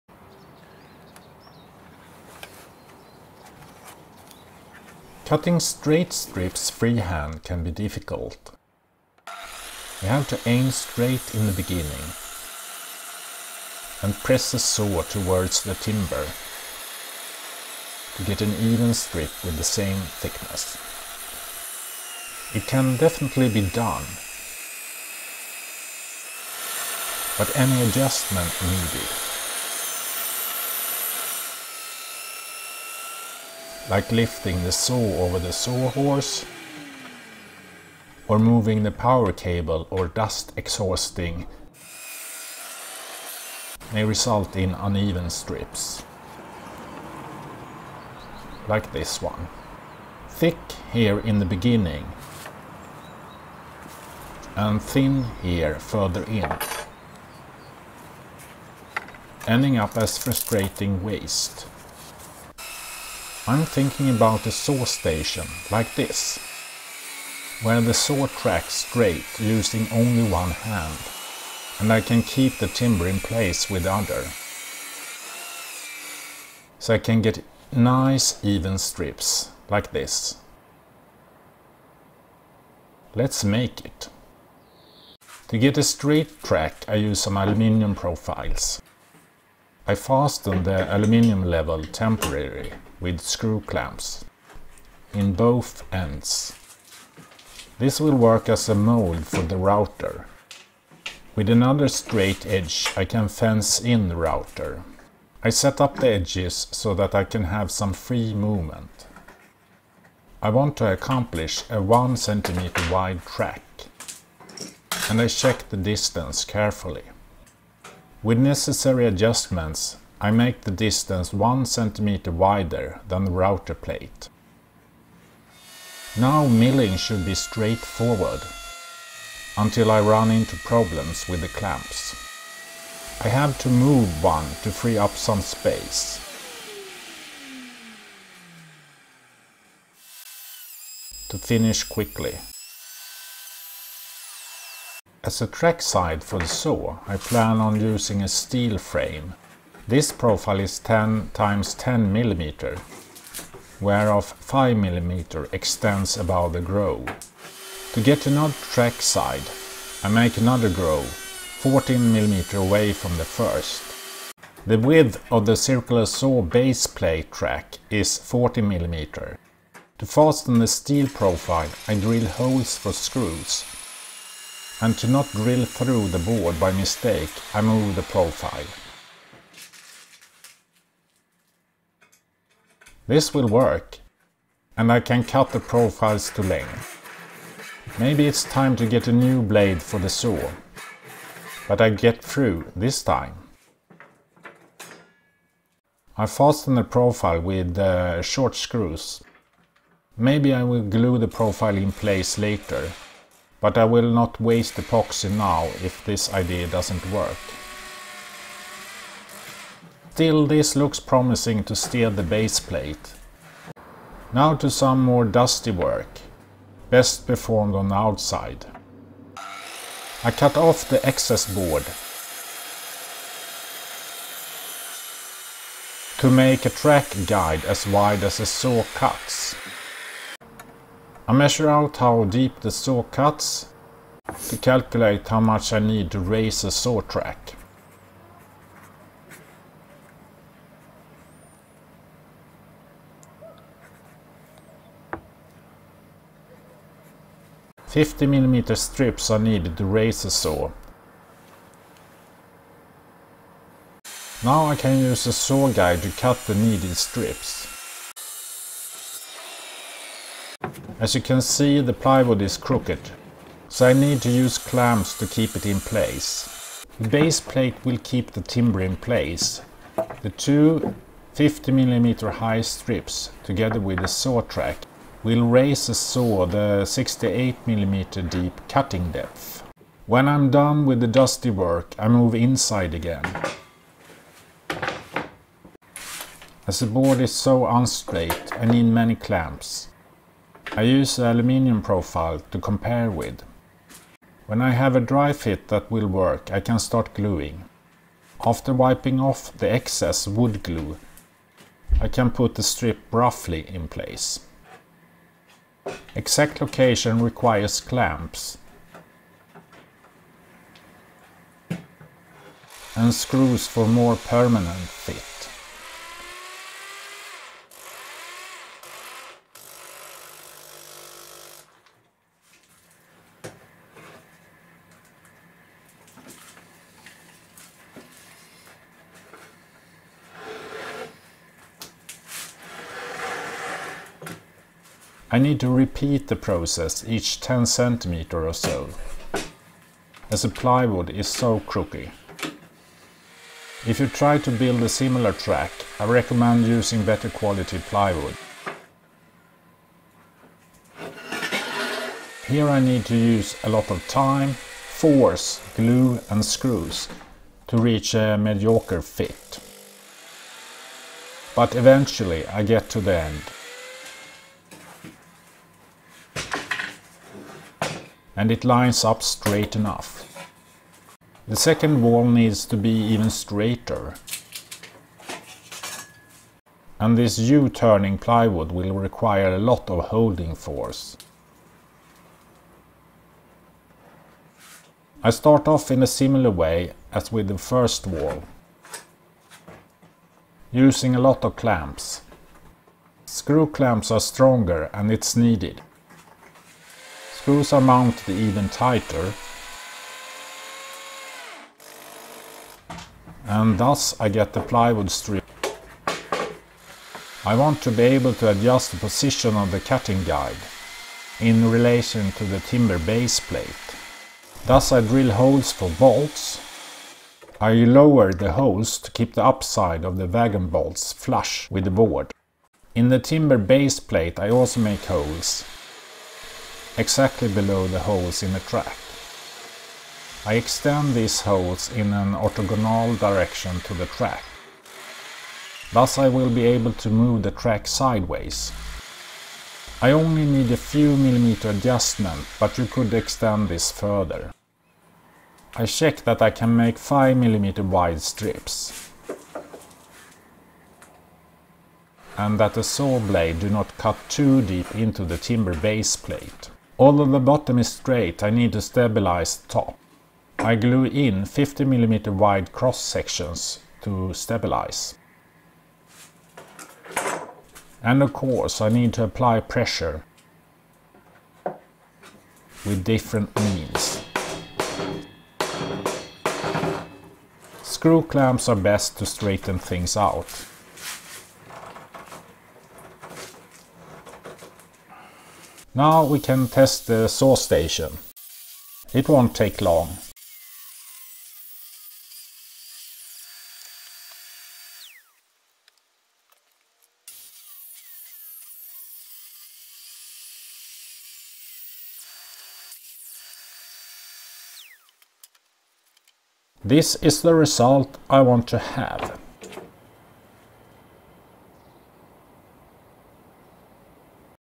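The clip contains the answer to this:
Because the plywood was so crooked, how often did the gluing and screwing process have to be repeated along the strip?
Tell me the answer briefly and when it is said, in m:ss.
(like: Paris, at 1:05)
Every 10 cm, at 5:37.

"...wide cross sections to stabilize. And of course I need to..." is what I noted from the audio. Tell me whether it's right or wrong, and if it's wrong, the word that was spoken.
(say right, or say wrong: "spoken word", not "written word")
right.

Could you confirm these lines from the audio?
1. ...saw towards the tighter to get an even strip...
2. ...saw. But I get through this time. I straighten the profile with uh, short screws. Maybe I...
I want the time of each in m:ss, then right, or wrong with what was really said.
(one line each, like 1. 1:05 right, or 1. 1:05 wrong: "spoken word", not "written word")
1. 0:14 wrong: "timber", not "tighter"
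2. 3:10 wrong: "fasten", not "straighten".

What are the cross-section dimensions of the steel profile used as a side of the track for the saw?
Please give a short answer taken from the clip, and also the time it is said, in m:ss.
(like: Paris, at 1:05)
10 x 10 mm, at 2:30.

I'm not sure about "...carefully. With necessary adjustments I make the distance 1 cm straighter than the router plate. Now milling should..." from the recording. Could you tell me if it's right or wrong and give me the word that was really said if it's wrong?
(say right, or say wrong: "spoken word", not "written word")
wrong: "wider", not "straighter".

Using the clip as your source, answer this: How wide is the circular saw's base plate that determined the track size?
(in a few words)
40 mm.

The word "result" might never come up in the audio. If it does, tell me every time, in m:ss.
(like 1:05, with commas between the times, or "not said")
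0:44, 8:27.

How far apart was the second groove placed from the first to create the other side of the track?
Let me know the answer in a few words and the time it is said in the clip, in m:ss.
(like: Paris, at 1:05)
14 mm, at 2:41.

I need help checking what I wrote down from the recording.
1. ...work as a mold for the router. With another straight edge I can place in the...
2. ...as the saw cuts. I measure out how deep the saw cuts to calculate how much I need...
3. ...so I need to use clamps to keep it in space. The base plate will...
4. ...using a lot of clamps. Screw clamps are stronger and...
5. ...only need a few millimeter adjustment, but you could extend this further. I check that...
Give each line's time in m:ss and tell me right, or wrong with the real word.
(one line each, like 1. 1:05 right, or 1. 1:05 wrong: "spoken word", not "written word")
1. 1:38 wrong: "fence", not "place"
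2. 3:48 right
3. 4:23 wrong: "place", not "space"
4. 6:30 right
5. 7:20 right.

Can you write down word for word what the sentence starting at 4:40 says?
When I'm done with the dusty work, I move inside again.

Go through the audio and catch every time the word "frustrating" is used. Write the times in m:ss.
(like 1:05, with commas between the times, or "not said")
1:00.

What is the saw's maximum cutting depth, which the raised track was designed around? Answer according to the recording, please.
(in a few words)
68 mm.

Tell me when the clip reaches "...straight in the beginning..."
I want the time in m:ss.
0:10.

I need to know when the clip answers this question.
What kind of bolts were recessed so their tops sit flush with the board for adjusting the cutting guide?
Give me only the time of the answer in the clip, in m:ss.
7:00.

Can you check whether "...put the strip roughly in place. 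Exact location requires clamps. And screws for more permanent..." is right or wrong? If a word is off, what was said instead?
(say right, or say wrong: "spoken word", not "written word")
right.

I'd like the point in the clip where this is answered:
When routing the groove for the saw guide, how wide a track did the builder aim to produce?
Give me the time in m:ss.
1:51.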